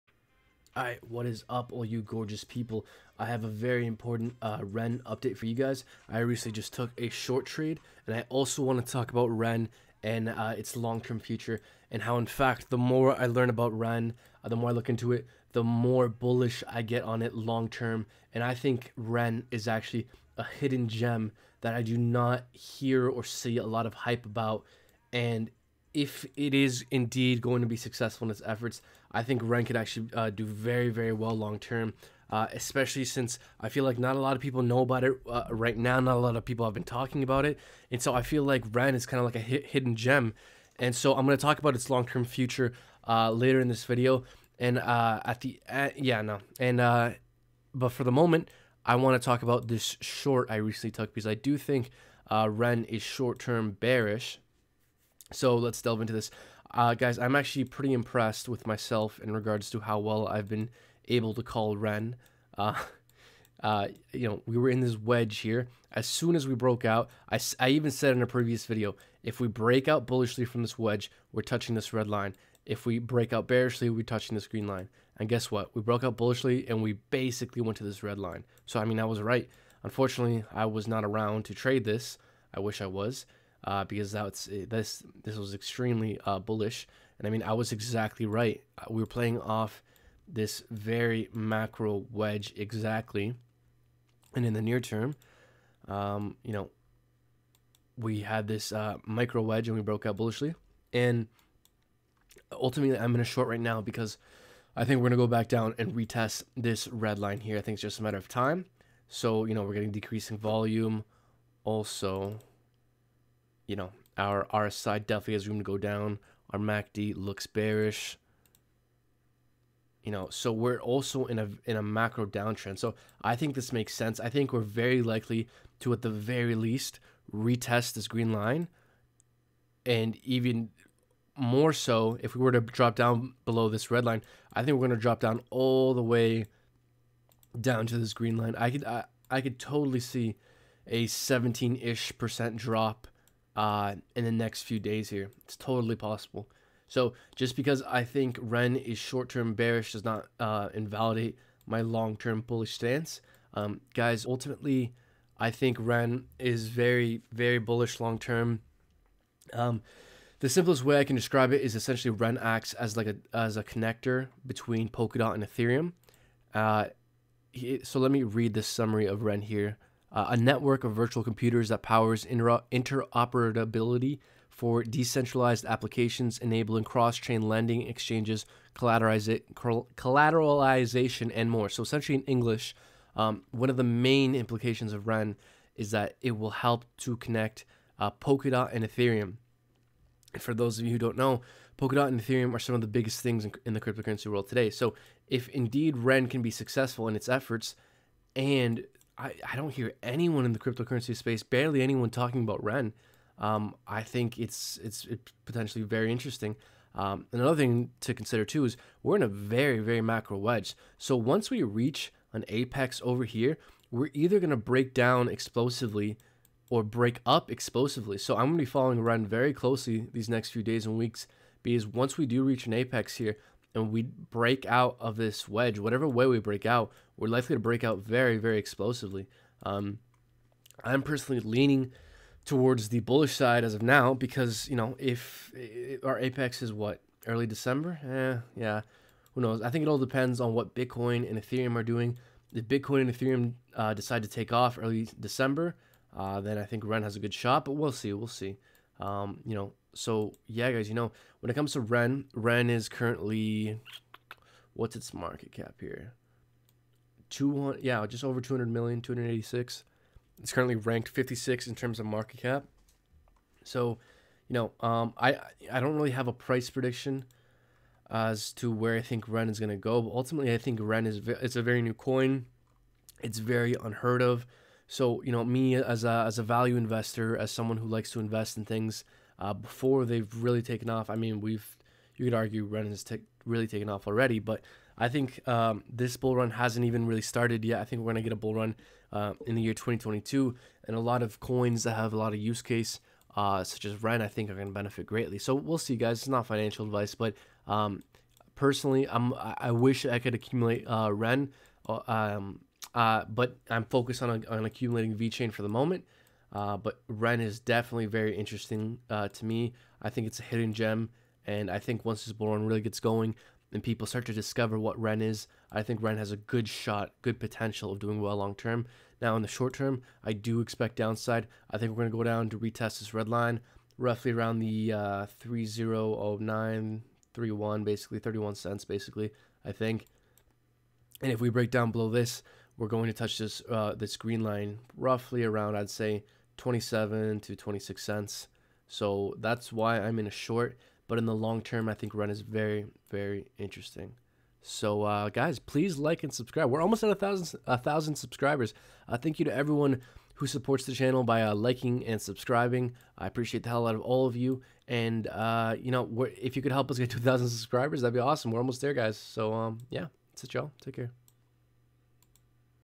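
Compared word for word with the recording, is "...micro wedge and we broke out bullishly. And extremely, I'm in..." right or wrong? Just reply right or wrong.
wrong.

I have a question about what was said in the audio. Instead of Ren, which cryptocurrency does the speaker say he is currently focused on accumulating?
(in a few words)
VeChain.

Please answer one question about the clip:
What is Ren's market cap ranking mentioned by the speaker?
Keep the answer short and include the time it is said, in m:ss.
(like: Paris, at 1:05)
56, at 4:20.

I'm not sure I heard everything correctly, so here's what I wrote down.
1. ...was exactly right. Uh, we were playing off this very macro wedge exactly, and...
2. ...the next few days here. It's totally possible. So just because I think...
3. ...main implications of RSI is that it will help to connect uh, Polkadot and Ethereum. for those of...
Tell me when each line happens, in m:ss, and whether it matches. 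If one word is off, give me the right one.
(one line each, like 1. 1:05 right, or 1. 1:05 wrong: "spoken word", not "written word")
1. 1:27 right
2. 2:24 right
3. 3:03 wrong: "REN", not "RSI".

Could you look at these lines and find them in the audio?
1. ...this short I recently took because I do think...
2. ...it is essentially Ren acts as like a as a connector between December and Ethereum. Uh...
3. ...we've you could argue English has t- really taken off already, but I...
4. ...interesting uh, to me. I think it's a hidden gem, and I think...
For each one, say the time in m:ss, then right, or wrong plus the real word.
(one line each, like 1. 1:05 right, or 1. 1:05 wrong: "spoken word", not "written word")
1. 0:49 right
2. 2:41 wrong: "Polkadot", not "December"
3. 4:41 wrong: "Ren", not "English"
4. 5:08 right.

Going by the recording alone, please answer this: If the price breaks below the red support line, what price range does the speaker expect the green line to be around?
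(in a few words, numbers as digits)
27 to 26 cents.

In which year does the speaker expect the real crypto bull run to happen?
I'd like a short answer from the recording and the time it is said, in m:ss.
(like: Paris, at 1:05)
2022, at 4:49.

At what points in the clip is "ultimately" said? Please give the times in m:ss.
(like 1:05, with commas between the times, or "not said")
1:42, 2:34, 4:30.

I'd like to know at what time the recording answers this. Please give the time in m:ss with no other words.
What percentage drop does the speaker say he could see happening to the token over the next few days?
2:21.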